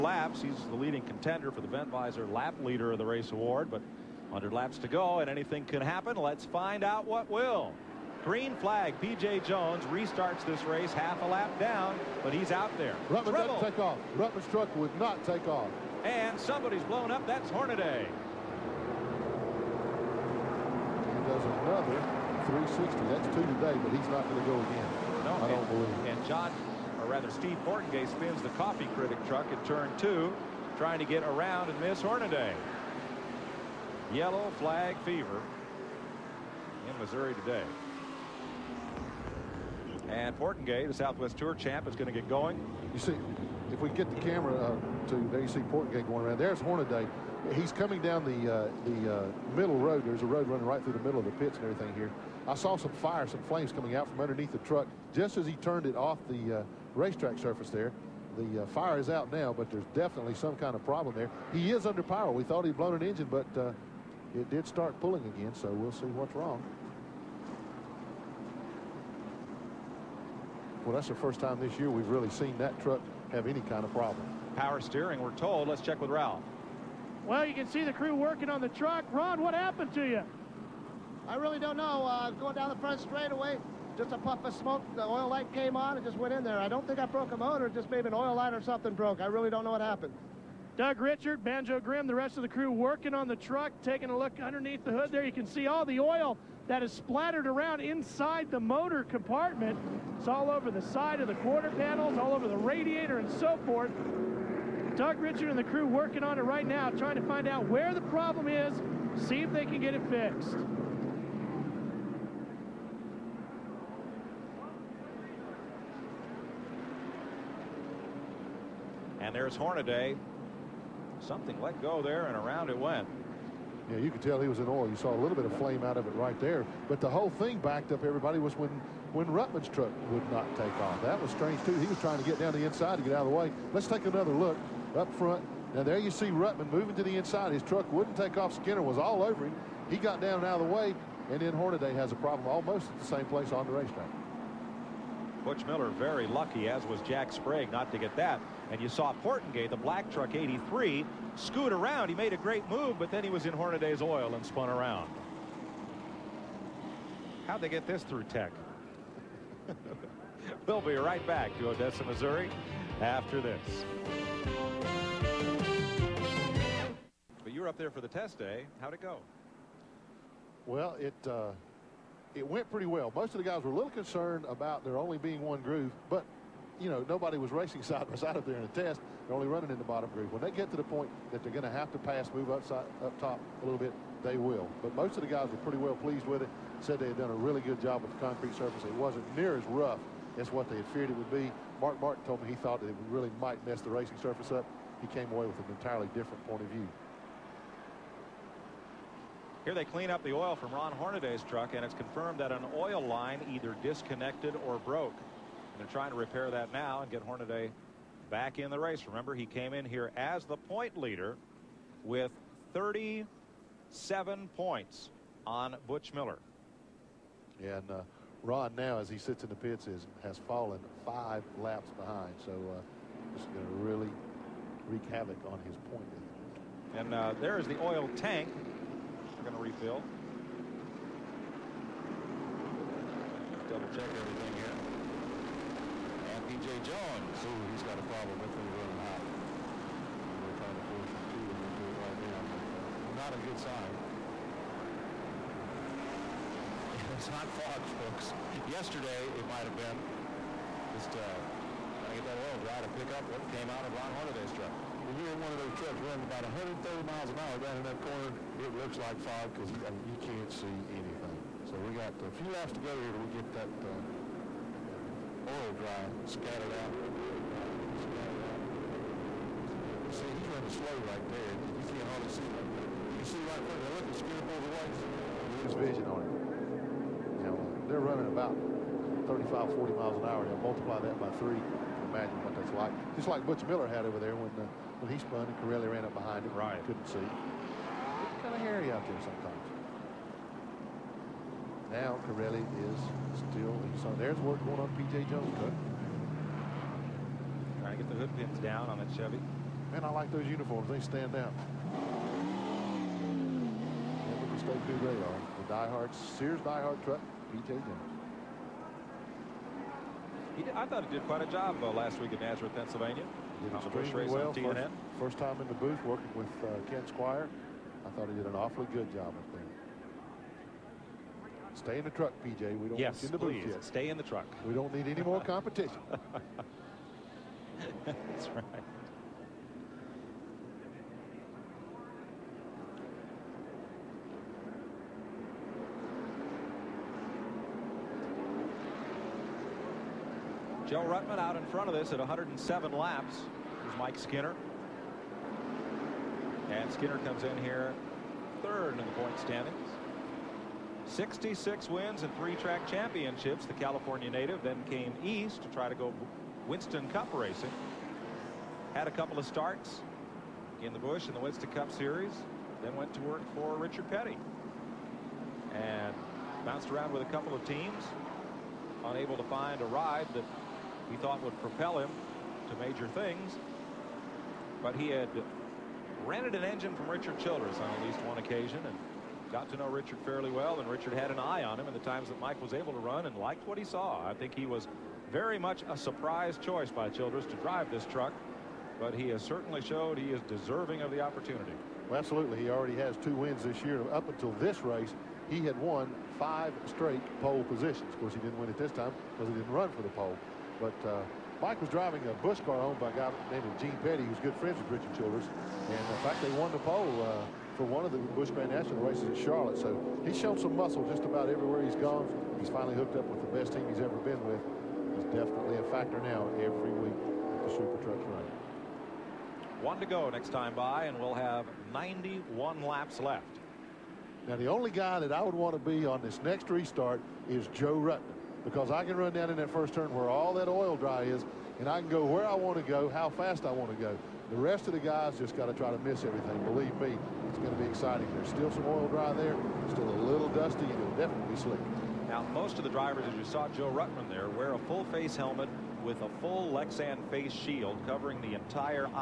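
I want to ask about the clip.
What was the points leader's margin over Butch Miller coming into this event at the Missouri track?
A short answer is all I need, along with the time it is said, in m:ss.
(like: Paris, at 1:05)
37 points, at 3:32.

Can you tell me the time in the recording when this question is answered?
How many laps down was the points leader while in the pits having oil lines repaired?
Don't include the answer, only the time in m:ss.
3:41.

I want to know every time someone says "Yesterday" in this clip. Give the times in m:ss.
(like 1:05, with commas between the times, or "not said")
4:08.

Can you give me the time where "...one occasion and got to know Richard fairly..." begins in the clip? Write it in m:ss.
6:18.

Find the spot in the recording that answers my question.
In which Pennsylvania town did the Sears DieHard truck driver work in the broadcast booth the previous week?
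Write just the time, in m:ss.
5:12.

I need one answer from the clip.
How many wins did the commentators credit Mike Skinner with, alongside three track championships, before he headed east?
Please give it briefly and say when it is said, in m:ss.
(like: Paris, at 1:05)
66, at 5:51.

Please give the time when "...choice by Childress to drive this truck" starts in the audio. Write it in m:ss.
6:26.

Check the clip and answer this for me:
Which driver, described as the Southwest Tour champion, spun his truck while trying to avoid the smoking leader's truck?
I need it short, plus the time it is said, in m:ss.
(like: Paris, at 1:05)
Steve Portenga, at 0:27.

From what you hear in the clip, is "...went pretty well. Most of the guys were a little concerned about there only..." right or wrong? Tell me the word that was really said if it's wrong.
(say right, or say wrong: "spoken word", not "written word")
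right.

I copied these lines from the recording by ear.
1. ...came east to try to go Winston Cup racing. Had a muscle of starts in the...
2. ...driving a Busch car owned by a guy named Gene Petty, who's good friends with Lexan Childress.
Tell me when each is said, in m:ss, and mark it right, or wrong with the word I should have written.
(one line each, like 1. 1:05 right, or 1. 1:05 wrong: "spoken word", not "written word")
1. 5:54 wrong: "couple", not "muscle"
2. 6:41 wrong: "Richard", not "Lexan".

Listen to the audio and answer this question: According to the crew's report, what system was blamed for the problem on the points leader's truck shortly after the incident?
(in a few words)
Power steering.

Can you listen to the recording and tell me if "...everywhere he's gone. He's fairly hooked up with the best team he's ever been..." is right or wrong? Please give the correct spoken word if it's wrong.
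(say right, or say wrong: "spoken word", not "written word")
wrong: "finally", not "fairly".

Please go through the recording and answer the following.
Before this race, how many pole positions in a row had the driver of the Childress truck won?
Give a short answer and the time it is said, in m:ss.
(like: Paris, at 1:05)
5, at 6:36.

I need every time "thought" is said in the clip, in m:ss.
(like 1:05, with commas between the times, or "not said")
1:02, 3:12, 5:10, 5:18, 6:11.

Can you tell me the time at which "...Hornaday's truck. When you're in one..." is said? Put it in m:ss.
4:14.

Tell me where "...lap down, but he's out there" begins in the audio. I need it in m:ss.
0:11.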